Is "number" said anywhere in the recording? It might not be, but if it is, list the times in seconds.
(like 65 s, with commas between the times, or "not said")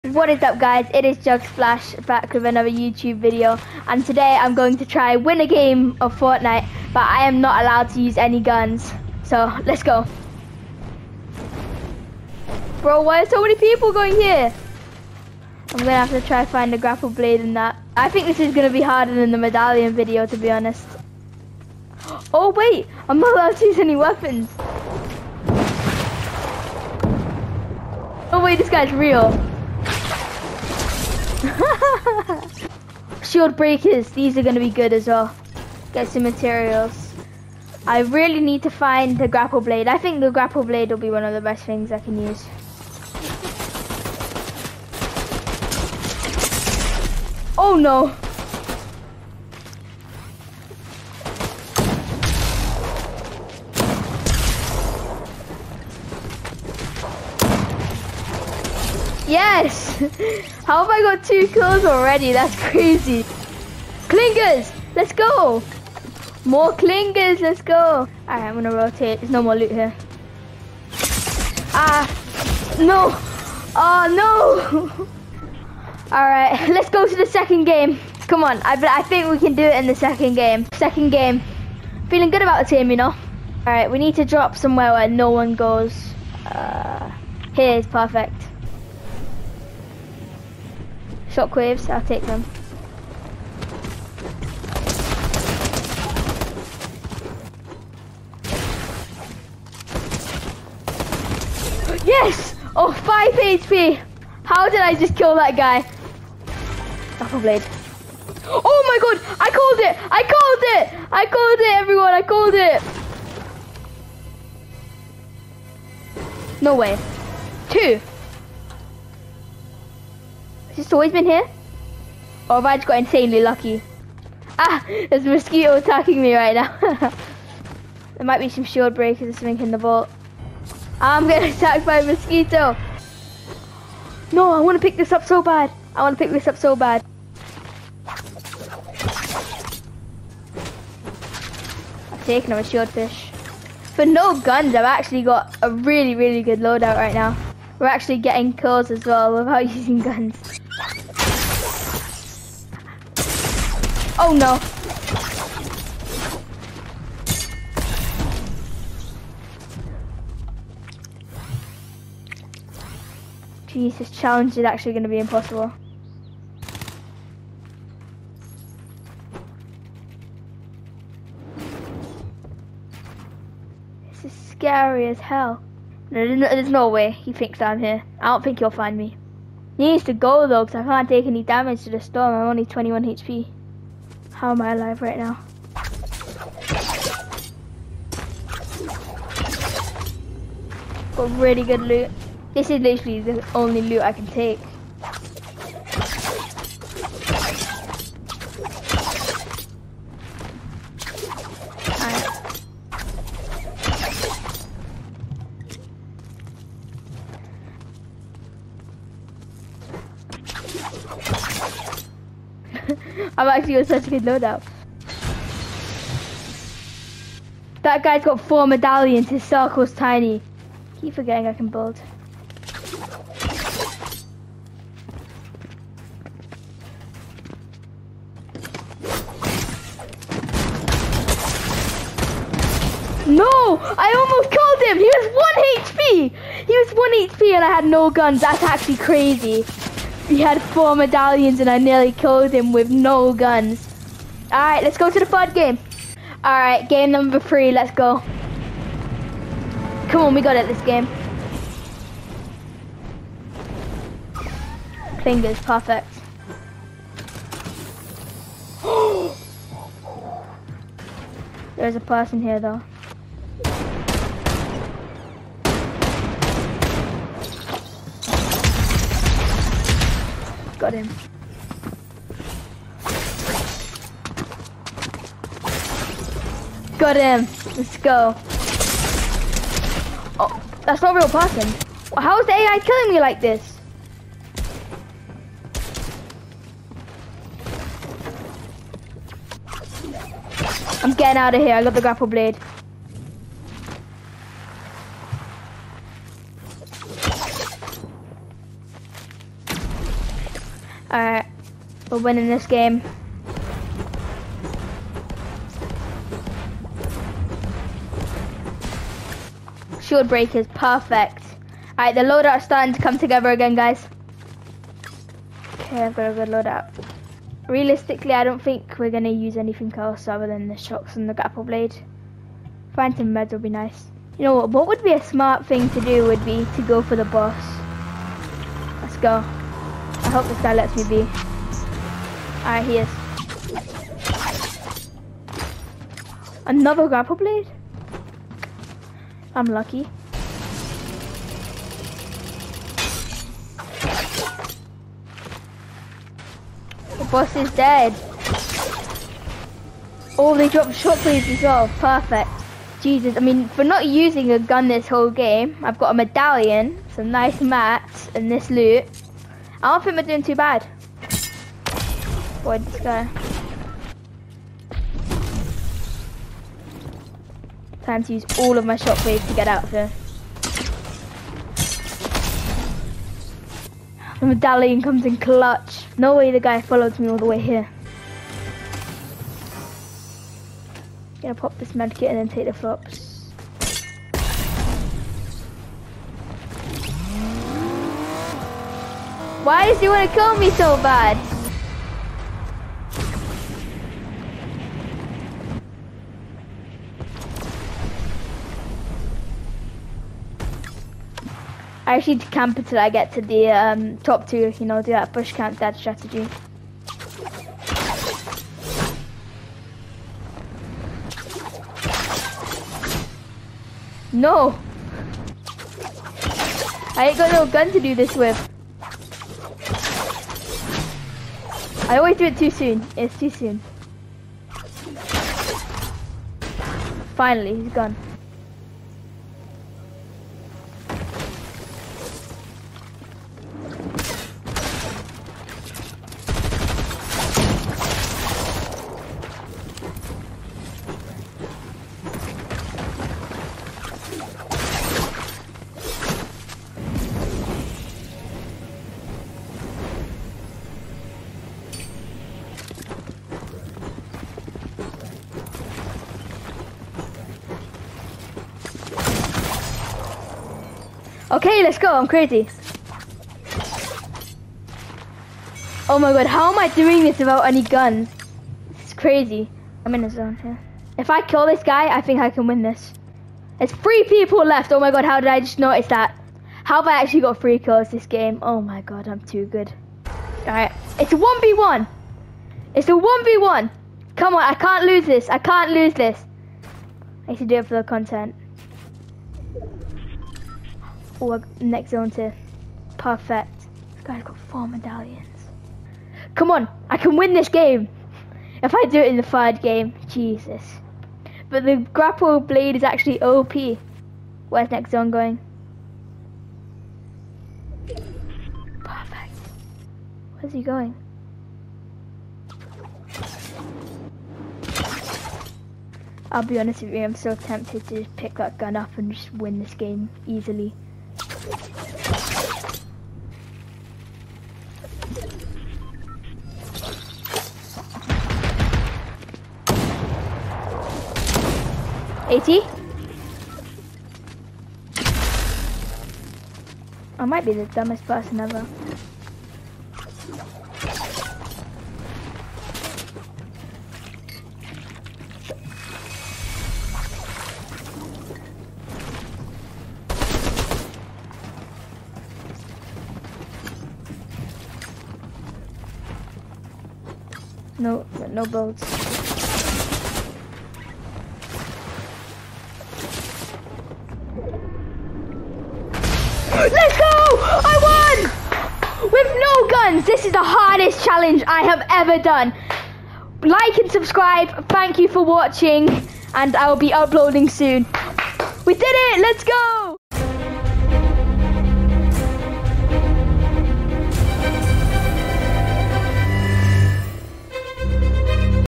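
247 s.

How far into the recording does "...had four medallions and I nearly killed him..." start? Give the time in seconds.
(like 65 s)
240 s.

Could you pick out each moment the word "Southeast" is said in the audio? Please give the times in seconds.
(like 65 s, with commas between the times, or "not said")
not said.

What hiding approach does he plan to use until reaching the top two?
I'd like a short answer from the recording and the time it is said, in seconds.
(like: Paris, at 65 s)
Bush camp, at 405 s.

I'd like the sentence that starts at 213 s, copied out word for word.
I'm actually on such a good loadout.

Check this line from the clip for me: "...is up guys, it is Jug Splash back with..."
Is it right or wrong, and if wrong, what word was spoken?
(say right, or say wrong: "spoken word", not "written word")
right.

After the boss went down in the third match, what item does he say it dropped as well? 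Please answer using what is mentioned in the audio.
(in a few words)
Shot blades.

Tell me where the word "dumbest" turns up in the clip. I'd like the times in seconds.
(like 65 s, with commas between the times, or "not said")
537 s.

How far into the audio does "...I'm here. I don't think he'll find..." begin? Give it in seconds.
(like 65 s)
177 s.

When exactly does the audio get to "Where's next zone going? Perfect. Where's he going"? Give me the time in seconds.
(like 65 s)
504 s.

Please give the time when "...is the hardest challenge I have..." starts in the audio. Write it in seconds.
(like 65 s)
570 s.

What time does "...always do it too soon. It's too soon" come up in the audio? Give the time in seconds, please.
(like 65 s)
422 s.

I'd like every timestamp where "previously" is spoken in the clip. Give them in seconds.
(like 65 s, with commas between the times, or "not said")
not said.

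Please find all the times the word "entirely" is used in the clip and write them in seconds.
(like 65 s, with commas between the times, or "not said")
not said.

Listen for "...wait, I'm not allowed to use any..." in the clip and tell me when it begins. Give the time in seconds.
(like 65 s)
22 s.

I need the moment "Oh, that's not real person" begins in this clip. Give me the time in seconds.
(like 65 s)
280 s.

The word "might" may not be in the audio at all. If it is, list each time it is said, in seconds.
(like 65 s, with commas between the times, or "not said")
128 s, 537 s.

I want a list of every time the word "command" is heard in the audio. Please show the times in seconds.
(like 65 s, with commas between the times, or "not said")
not said.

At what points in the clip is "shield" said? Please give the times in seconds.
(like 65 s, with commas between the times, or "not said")
33 s, 128 s, 142 s, 309 s.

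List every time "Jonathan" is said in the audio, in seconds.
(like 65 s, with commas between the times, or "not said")
not said.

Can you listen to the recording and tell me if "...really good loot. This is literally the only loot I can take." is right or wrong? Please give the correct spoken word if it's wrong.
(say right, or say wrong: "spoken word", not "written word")
right.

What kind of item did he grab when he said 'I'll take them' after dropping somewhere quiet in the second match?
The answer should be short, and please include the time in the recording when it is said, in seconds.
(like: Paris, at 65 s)
Shockwaves, at 91 s.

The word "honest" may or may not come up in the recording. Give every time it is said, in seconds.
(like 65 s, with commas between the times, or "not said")
20 s, 516 s.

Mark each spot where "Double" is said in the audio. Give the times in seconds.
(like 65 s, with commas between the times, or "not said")
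107 s.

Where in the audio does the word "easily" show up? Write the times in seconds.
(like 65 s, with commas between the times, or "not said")
520 s.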